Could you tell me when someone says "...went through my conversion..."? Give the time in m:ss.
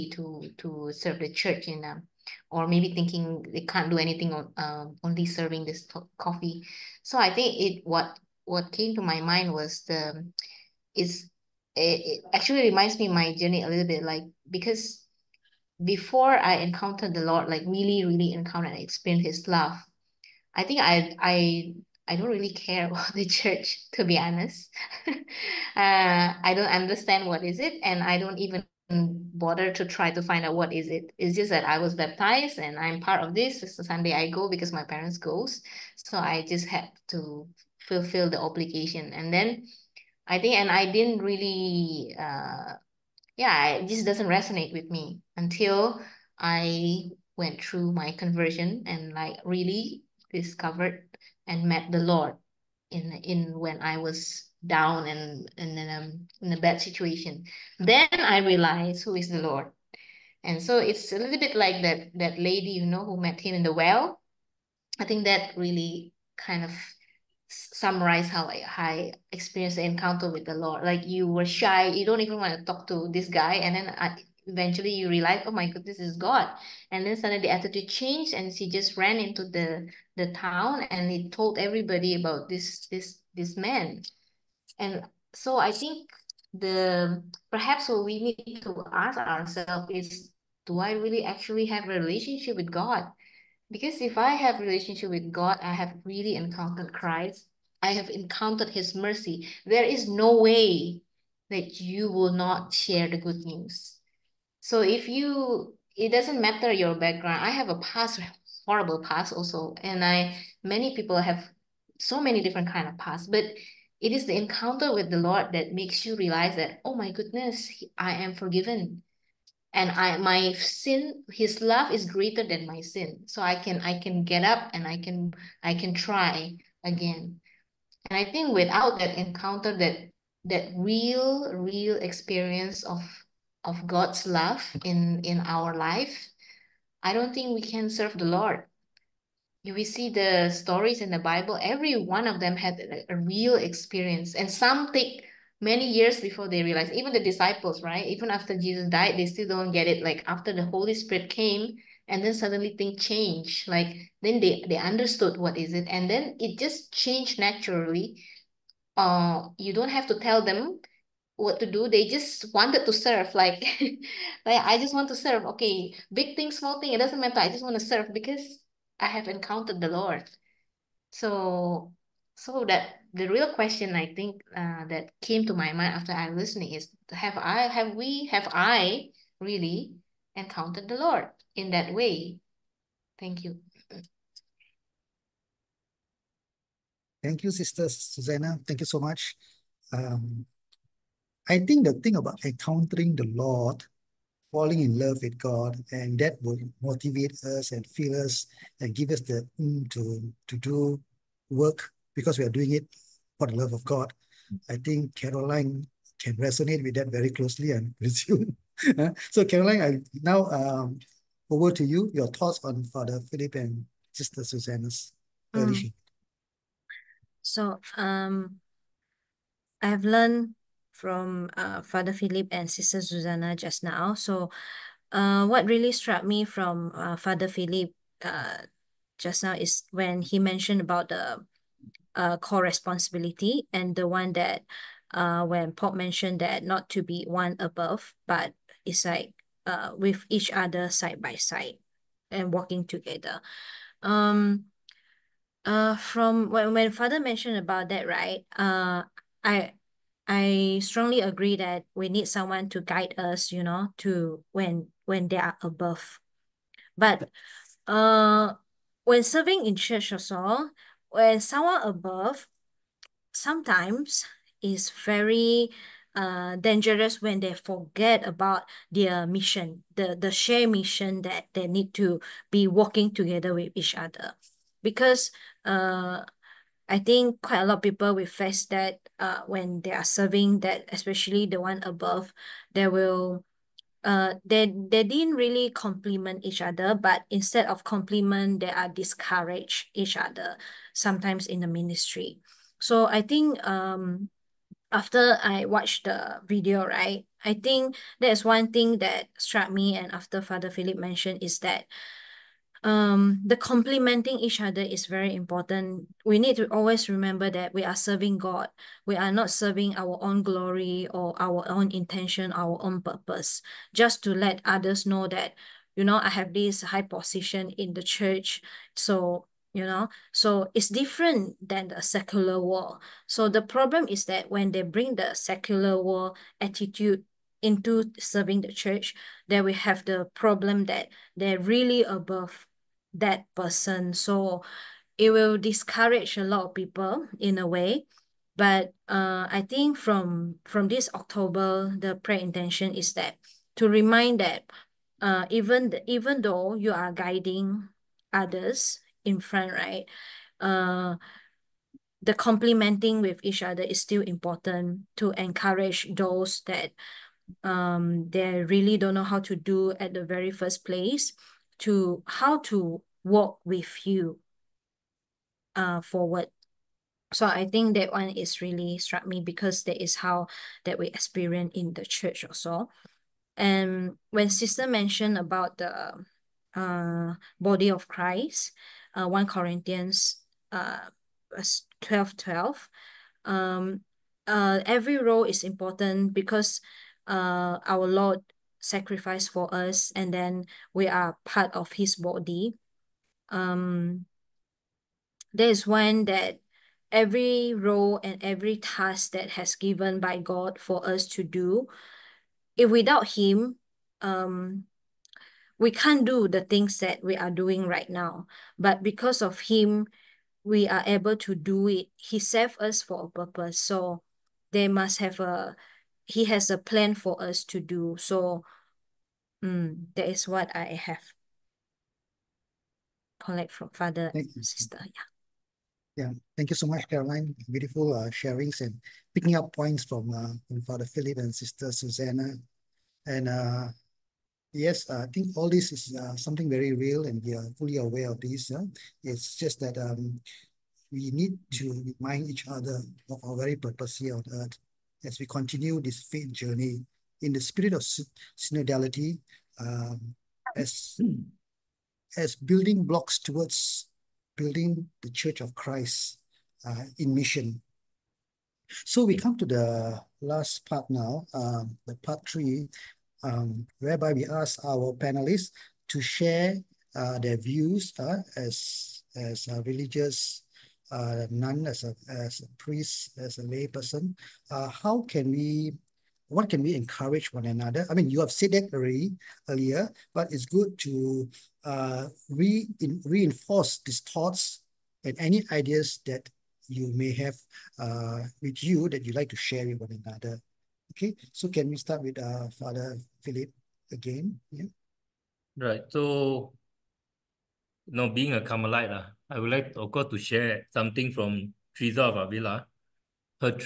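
0:47.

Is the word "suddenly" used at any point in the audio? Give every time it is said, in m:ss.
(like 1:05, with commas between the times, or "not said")
1:17, 2:32.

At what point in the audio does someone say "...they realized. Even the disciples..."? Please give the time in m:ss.
2:26.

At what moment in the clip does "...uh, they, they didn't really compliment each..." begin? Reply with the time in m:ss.
4:44.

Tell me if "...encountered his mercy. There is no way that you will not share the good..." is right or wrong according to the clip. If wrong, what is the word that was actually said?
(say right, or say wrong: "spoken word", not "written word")
right.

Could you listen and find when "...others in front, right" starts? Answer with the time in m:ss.
5:48.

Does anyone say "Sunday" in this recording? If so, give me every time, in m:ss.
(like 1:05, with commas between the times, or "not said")
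0:33.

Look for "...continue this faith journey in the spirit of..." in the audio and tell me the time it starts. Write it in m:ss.
7:25.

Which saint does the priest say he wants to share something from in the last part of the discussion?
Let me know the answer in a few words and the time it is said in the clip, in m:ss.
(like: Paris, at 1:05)
Teresa of Avila, at 8:21.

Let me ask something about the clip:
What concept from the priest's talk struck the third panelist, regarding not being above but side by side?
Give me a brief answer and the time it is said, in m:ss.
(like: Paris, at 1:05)
Co-responsibility, at 3:52.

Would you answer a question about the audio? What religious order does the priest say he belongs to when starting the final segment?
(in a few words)
Carmelite.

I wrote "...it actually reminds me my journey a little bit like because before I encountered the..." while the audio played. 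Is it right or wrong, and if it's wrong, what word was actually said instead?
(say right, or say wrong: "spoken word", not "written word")
right.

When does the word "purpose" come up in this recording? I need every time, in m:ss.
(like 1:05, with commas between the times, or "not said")
5:13, 6:53, 7:23.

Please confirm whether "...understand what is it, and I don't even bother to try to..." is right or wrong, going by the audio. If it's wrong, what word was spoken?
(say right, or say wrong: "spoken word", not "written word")
right.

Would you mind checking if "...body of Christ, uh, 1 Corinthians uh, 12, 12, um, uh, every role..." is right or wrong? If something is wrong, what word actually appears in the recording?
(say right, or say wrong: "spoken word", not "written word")
right.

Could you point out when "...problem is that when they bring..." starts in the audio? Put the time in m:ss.
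5:23.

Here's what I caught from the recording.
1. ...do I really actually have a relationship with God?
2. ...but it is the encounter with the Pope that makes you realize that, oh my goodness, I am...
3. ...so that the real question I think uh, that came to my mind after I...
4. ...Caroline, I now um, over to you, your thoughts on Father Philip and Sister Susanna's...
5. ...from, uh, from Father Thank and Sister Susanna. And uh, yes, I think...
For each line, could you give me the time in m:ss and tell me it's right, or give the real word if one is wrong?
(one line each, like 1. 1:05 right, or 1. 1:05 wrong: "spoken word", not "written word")
1. 1:30 right
2. 1:53 wrong: "Lord", not "Pope"
3. 2:52 right
4. 3:29 right
5. 7:10 wrong: "Philip", not "Thank".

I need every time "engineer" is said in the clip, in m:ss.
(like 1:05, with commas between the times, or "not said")
not said.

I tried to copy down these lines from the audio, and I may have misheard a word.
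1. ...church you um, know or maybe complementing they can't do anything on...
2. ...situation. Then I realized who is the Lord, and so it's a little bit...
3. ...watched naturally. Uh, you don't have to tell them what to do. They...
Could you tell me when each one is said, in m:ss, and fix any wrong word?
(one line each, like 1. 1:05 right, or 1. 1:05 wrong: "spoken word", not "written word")
1. 0:01 wrong: "thinking", not "complementing"
2. 0:56 right
3. 2:36 wrong: "changed", not "watched".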